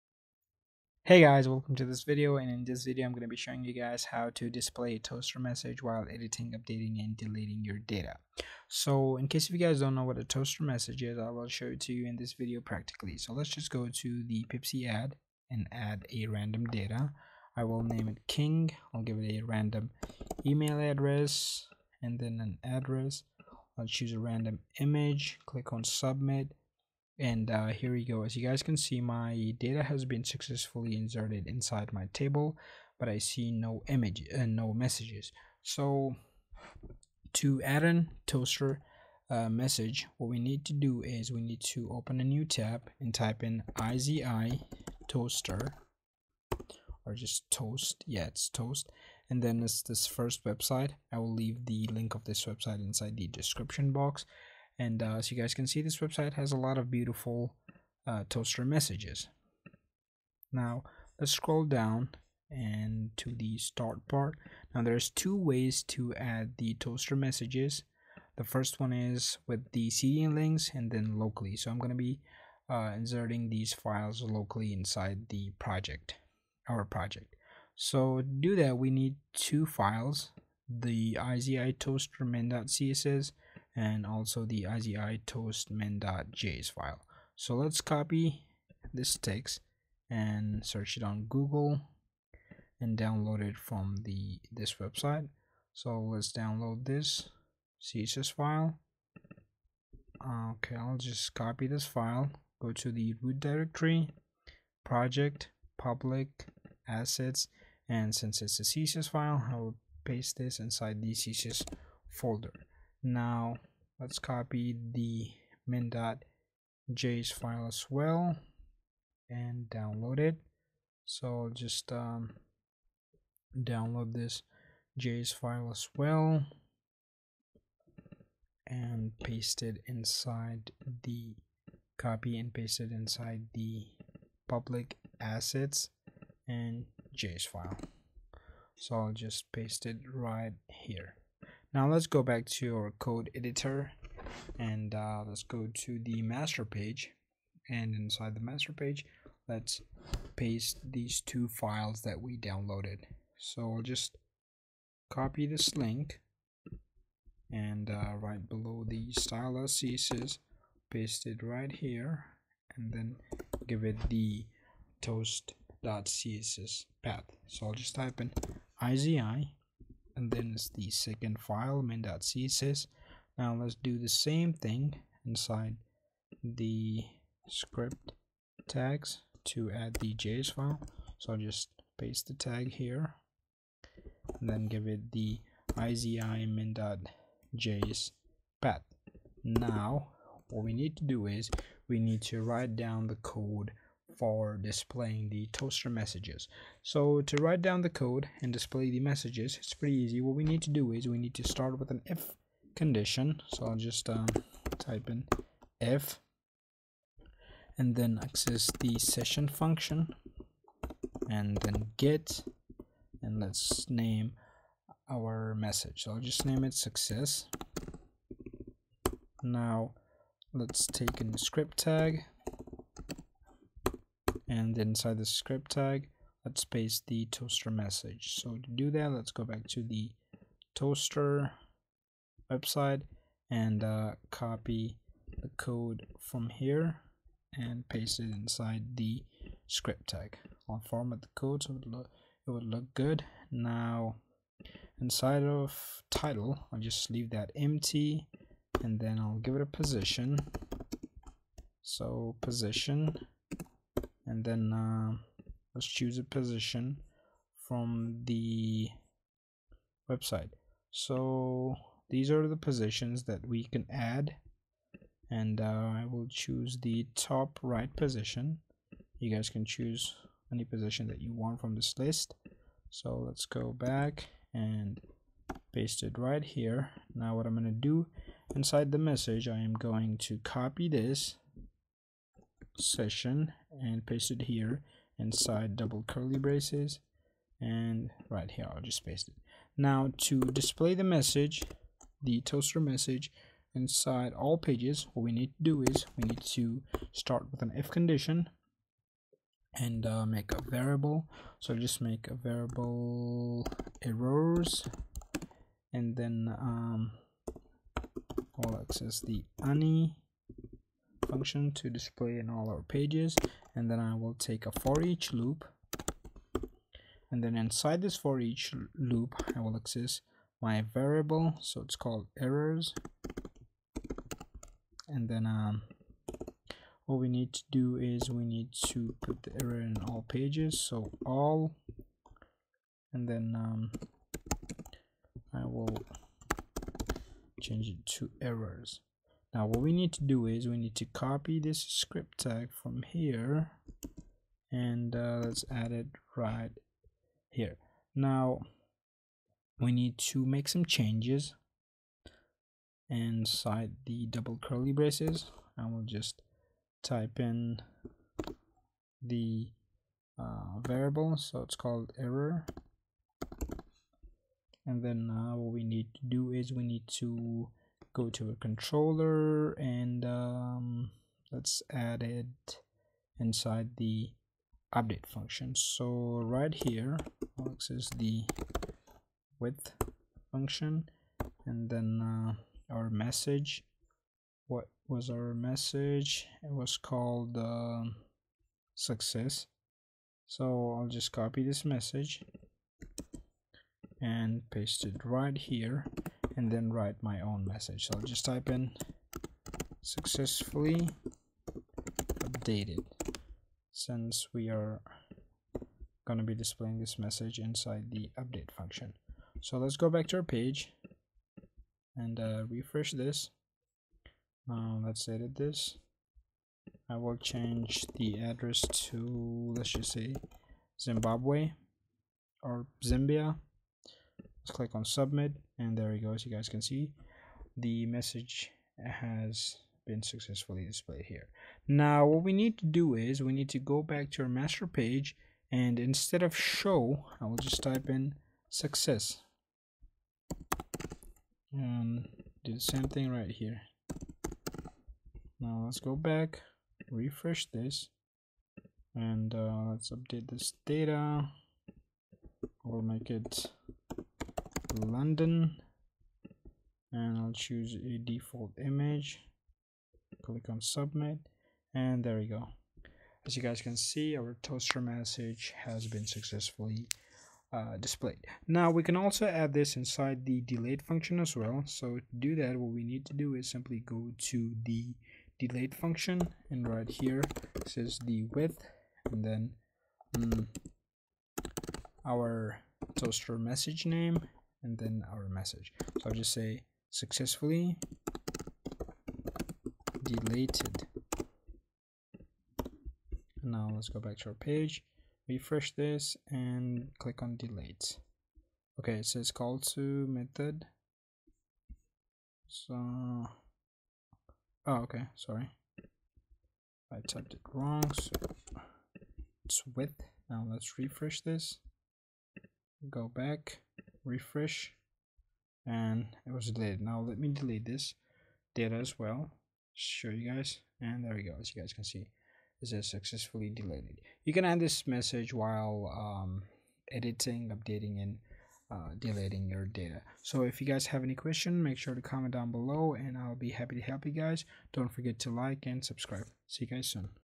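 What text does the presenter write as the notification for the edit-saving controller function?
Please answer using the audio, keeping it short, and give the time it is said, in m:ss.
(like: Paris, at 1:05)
successfully updated, at 6:40.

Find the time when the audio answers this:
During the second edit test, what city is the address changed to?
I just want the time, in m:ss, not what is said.
7:34.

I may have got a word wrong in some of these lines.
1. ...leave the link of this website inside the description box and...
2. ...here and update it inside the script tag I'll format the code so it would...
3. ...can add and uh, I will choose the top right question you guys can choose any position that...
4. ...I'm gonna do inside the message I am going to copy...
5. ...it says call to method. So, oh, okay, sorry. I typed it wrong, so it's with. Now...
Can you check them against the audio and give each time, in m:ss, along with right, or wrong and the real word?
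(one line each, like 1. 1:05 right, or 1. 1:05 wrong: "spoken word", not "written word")
1. 0:51 right
2. 3:56 wrong: "paste", not "update"
3. 4:23 wrong: "position", not "question"
4. 4:37 right
5. 8:19 right.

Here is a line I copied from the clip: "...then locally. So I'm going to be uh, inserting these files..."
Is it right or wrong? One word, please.
right.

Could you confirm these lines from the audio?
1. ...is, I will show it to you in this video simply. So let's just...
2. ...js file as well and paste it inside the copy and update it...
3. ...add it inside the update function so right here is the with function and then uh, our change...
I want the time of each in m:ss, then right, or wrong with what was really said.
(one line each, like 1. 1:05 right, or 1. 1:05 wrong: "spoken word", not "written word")
1. 0:11 wrong: "practically", not "simply"
2. 2:04 wrong: "paste", not "update"
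3. 6:11 wrong: "message", not "change".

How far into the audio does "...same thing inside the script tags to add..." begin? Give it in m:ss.
2:54.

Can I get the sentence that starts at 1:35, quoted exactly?
So let's download this CSS file.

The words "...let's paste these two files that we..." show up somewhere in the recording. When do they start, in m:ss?
2:29.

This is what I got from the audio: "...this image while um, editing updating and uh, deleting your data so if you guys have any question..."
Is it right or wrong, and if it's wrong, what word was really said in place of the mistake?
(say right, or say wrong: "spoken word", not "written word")
wrong: "message", not "image".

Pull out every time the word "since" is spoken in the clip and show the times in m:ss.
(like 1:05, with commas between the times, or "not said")
1:48, 6:43.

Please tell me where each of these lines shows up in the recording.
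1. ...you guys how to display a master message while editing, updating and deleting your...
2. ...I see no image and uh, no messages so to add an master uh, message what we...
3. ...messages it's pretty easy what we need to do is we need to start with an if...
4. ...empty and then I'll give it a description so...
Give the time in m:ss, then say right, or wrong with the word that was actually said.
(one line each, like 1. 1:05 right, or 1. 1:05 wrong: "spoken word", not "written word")
1. 0:03 wrong: "toaster", not "master"
2. 0:33 wrong: "toaster", not "master"
3. 3:18 right
4. 4:07 wrong: "position", not "description".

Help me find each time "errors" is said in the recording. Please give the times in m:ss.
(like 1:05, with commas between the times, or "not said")
5:04, 5:22, 5:29, 5:38, 6:02.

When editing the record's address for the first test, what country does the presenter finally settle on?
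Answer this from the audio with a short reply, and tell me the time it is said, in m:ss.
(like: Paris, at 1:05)
Zambia, at 7:03.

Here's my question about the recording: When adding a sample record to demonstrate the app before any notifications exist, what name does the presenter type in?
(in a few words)
King.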